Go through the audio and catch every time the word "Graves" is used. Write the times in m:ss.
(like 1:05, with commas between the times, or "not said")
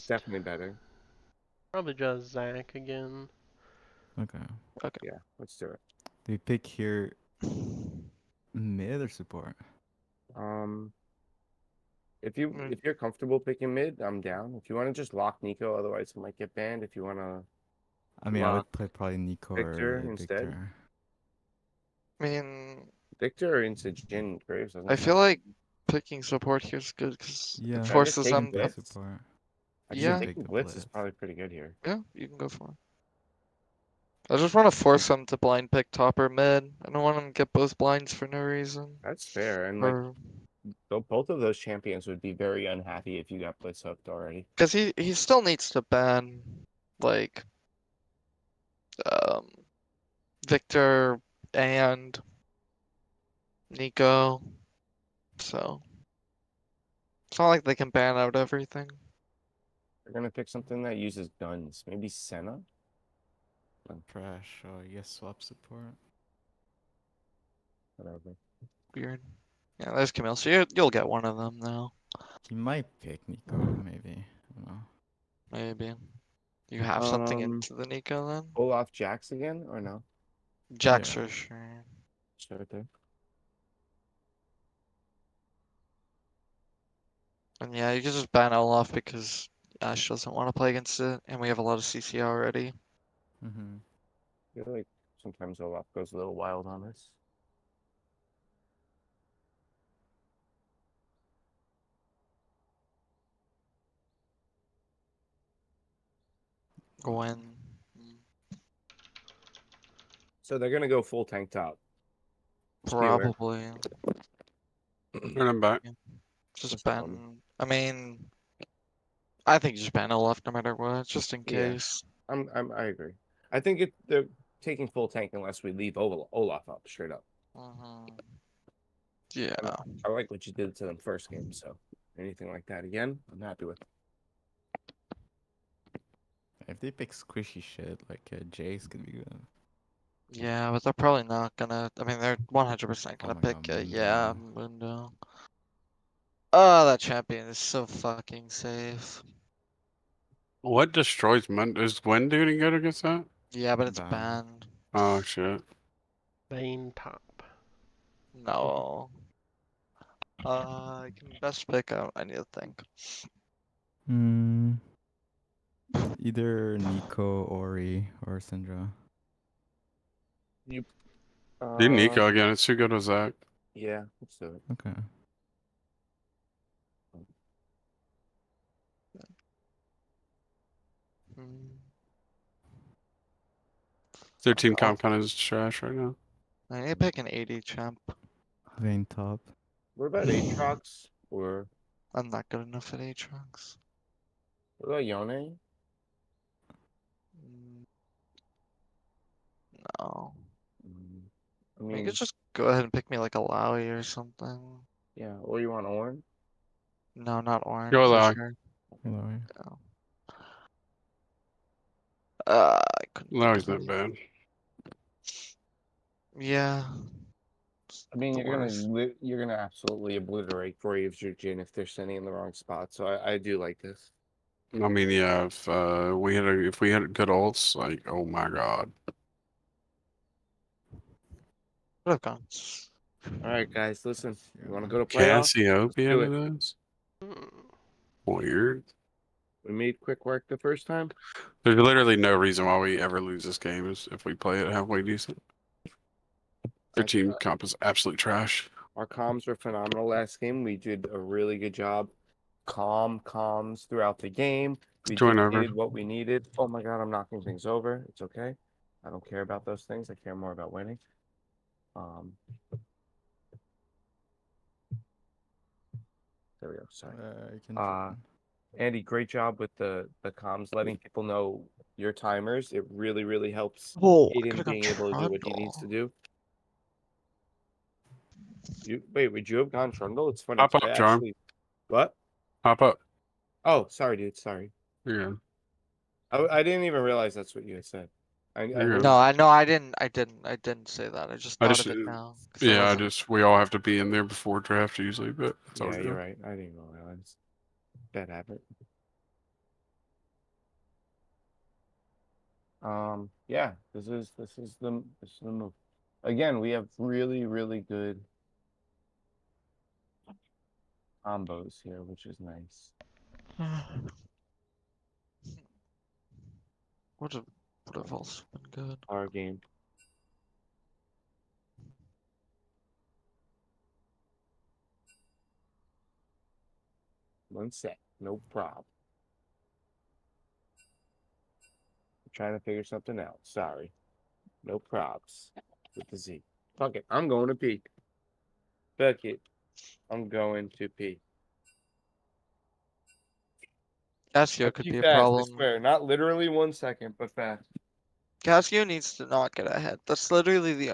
0:24, 3:40.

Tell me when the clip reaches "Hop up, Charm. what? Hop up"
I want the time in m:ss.
4:40.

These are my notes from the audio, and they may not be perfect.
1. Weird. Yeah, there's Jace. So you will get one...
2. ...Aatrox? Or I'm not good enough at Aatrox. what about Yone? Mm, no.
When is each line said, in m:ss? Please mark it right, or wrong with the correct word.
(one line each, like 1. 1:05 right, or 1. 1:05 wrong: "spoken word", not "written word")
1. 1:08 wrong: "Camille", not "Jace"
2. 3:10 right.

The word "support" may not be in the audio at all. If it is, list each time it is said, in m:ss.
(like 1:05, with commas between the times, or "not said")
0:09, 0:26, 1:05.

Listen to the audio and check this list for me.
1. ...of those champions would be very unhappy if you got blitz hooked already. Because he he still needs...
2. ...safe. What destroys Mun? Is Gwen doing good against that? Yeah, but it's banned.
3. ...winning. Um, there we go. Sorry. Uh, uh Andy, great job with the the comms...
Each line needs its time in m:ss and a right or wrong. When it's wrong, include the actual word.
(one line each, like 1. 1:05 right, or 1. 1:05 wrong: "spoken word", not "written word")
1. 0:41 right
2. 2:28 right
3. 4:20 right.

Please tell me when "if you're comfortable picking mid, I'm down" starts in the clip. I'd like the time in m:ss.
0:12.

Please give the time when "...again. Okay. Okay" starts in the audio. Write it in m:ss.
0:02.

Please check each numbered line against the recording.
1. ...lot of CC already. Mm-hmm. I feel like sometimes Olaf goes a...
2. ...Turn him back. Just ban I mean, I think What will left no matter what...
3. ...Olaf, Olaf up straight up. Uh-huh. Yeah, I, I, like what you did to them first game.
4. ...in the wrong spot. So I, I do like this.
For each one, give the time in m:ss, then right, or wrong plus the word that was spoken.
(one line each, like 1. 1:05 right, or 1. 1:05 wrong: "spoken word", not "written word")
1. 1:31 right
2. 1:55 wrong: "Japan", not "What"
3. 2:05 right
4. 3:42 right.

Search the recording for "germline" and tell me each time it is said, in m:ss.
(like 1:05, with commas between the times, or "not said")
not said.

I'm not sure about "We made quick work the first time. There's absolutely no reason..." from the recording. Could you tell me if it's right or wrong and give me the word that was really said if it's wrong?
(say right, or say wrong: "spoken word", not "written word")
wrong: "literally", not "absolutely".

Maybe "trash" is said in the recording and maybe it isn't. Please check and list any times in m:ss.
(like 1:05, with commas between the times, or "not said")
3:05, 4:08.